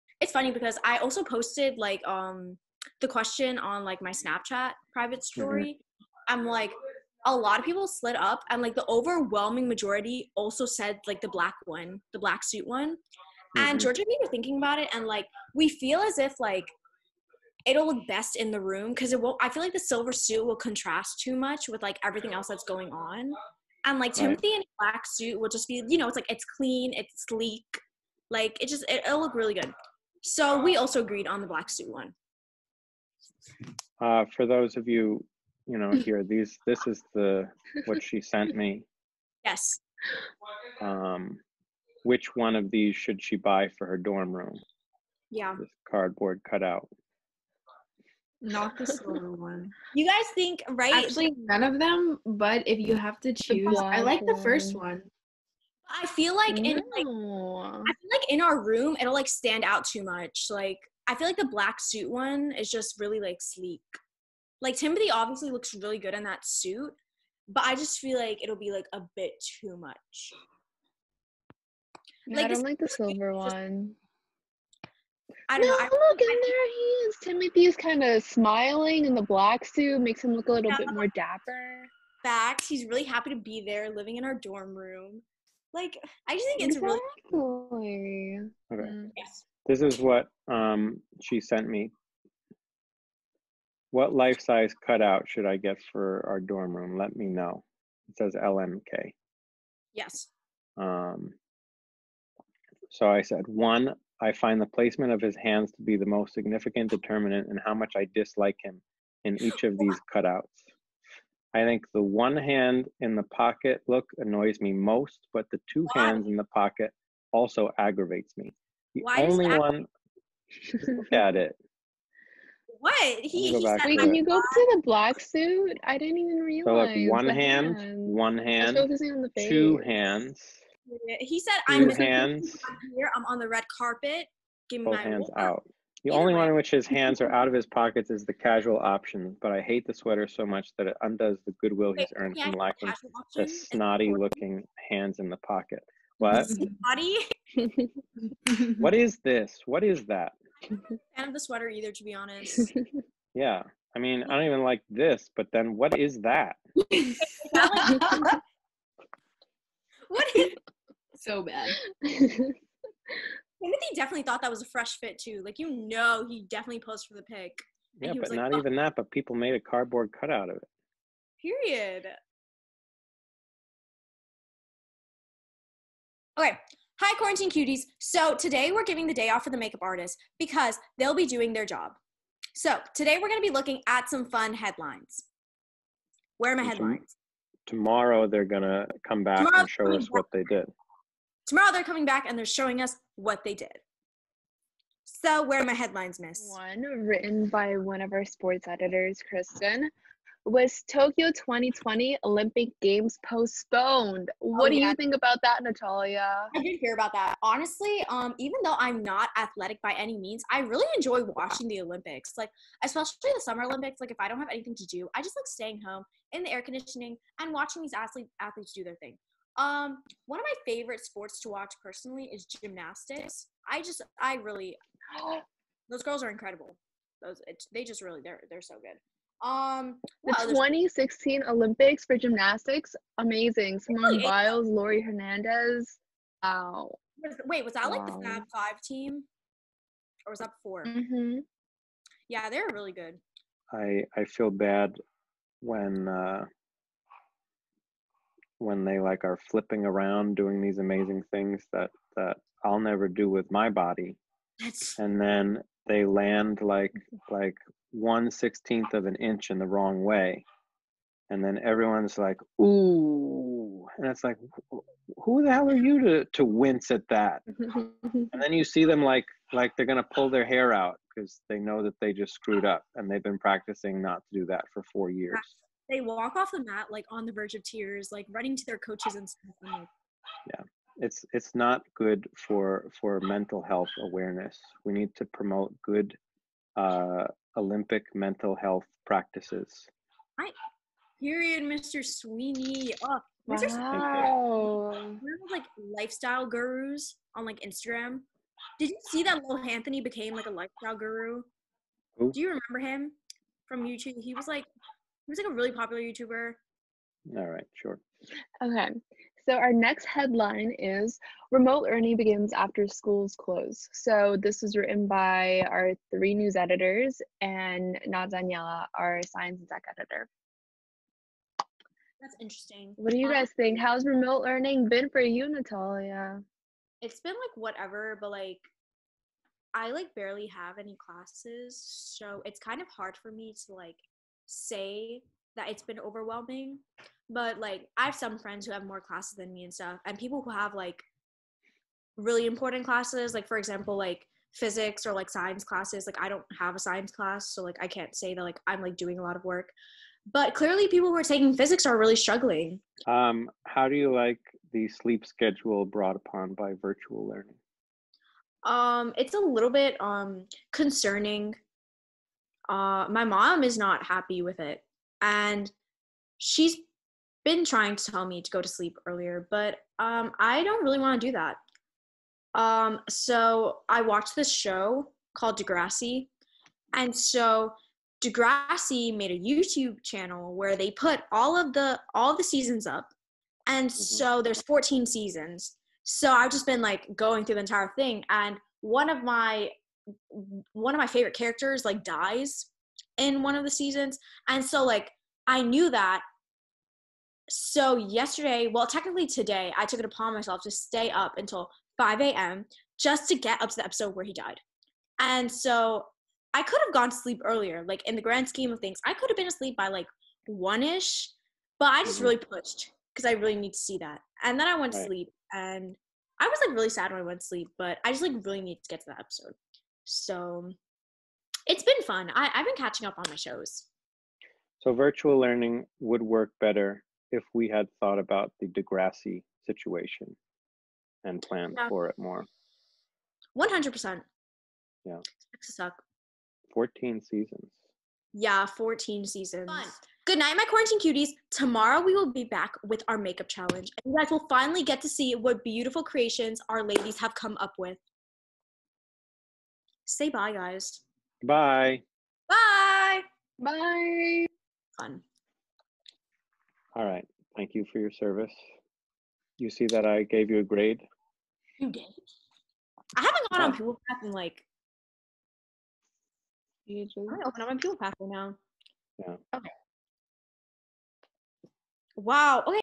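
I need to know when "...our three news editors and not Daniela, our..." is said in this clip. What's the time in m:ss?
5:15.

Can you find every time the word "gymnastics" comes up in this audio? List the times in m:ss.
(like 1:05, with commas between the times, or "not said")
3:42, 3:52.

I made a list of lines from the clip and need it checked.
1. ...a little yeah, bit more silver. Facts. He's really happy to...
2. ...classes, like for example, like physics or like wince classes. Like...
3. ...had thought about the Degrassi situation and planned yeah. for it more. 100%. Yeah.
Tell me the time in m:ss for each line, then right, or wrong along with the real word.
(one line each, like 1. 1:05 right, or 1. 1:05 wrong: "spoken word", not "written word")
1. 1:20 wrong: "dapper", not "silver"
2. 5:42 wrong: "science", not "wince"
3. 7:07 right.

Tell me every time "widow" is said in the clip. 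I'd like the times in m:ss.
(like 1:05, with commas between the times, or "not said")
not said.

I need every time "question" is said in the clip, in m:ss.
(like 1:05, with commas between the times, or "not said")
0:03.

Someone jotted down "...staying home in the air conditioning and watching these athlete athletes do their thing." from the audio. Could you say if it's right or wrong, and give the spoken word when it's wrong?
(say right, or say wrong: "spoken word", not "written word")
right.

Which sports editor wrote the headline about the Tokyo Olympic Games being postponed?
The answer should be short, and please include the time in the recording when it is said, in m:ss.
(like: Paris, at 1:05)
Kristen, at 3:19.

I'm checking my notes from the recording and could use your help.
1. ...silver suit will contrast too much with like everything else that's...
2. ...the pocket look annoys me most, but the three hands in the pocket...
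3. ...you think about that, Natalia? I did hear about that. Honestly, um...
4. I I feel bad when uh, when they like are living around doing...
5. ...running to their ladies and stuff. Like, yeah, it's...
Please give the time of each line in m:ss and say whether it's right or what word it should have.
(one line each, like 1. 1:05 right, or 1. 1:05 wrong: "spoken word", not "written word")
1. 0:19 right
2. 1:53 wrong: "two", not "three"
3. 3:24 right
4. 4:03 wrong: "flipping", not "living"
5. 4:38 wrong: "coaches", not "ladies".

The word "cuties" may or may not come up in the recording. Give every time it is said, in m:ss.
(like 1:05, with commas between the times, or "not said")
2:57, 7:20.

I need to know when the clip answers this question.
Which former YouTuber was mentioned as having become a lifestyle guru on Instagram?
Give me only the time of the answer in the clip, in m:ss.
4:59.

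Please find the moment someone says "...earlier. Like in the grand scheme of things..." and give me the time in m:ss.
6:47.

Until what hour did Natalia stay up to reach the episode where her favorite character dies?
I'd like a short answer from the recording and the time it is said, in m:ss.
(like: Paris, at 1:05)
5 a.m., at 6:41.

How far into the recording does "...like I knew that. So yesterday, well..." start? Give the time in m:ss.
6:34.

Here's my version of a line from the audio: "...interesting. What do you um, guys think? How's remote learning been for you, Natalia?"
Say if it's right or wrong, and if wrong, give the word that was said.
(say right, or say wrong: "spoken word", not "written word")
right.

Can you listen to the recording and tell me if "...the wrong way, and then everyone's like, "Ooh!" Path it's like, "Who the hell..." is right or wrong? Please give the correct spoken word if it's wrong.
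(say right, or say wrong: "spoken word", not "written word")
wrong: "And", not "Path".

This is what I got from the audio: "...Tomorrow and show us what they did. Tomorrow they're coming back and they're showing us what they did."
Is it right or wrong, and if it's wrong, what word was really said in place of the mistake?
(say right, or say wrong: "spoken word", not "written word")
right.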